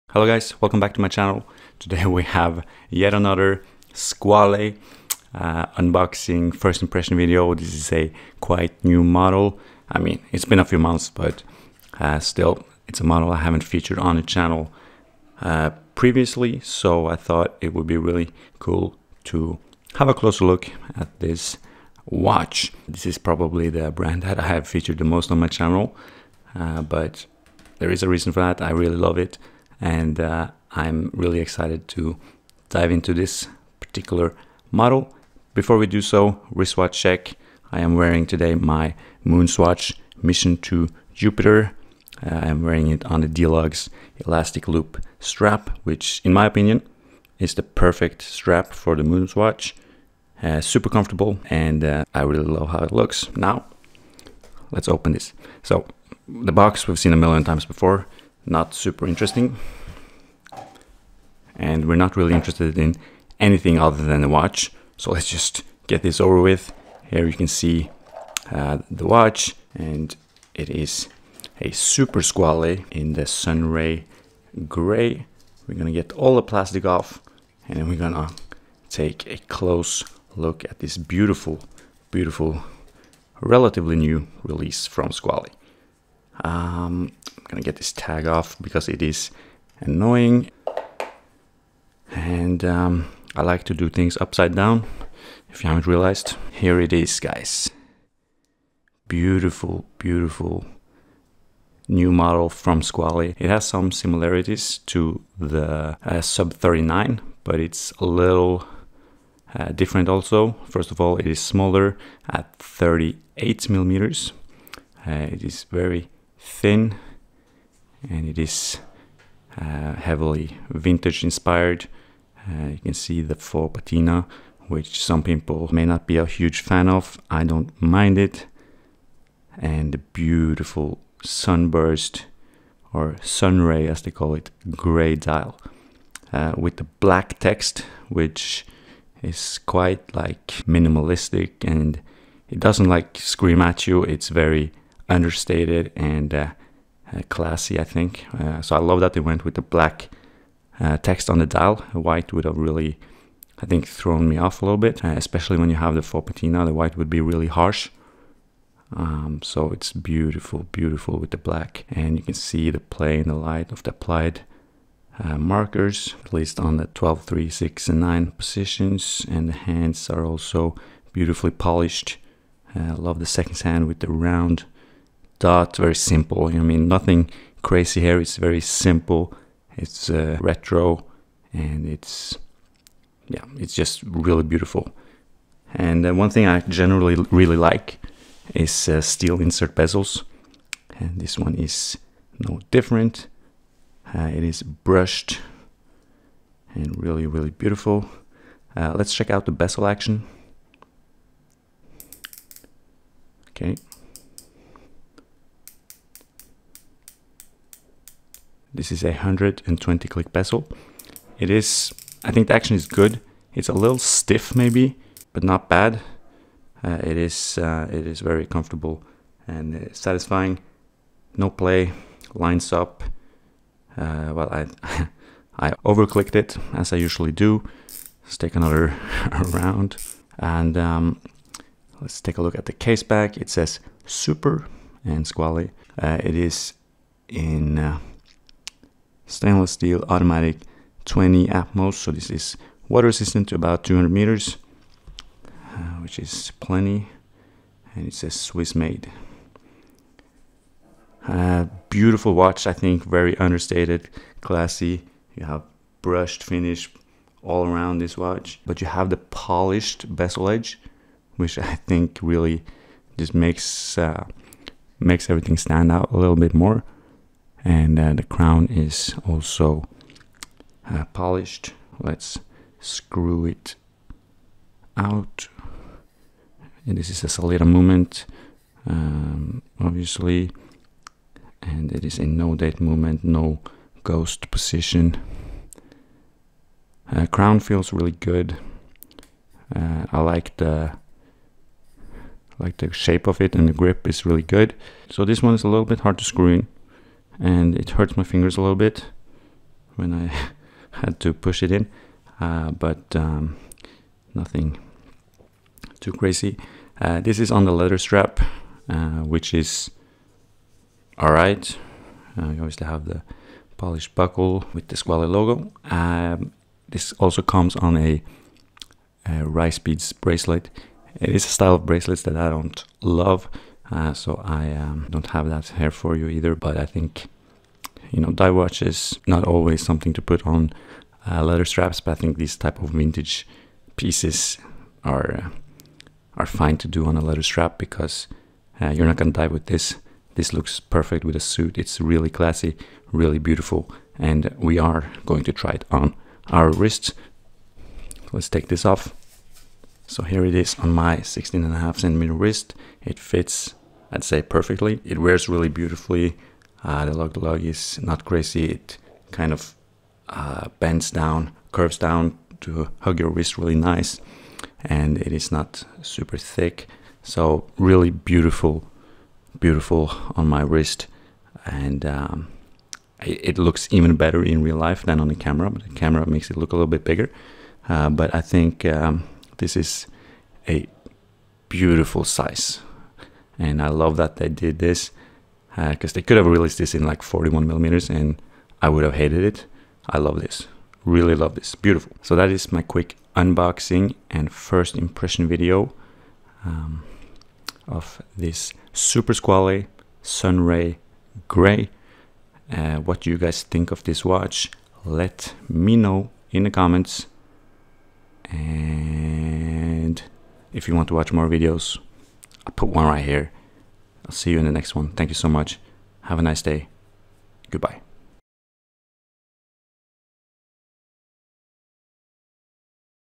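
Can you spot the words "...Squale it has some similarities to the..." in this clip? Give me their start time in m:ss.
1:42.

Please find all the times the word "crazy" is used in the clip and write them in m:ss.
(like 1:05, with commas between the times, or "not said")
2:57, 5:06, 5:58.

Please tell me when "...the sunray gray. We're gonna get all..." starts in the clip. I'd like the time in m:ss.
1:13.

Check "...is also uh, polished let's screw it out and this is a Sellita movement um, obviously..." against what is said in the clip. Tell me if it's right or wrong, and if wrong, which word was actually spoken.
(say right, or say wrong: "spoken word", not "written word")
right.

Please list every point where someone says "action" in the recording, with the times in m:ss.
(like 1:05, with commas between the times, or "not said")
3:19, 3:32.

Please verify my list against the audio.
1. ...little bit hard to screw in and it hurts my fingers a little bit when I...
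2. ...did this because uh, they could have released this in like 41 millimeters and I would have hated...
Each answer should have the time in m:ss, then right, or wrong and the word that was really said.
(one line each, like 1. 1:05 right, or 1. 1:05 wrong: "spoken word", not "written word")
1. 4:55 right
2. 6:24 right.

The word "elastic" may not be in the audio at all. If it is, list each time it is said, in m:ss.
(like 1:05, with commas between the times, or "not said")
0:44.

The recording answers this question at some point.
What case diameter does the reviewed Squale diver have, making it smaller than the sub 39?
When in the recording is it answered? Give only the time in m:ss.
1:52.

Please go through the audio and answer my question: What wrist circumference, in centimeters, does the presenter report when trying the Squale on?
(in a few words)
16.5 centimeters.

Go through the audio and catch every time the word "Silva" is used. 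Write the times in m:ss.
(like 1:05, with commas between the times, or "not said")
not said.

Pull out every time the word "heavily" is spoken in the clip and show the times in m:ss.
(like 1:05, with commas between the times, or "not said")
1:59.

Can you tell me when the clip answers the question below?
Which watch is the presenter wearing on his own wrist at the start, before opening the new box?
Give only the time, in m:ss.
0:39.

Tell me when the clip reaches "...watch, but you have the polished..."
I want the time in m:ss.
4:18.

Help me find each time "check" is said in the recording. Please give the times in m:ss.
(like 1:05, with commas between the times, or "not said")
0:37, 3:19.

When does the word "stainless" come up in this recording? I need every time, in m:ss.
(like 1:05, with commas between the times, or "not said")
3:59.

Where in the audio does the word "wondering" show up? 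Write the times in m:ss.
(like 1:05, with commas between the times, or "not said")
not said.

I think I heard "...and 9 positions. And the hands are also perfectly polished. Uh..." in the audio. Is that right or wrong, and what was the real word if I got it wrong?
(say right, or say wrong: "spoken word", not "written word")
wrong: "beautifully", not "perfectly".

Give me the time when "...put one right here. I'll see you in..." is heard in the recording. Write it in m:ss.
6:52.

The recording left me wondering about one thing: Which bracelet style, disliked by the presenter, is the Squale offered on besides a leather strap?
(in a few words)
Rice Beads bracelet.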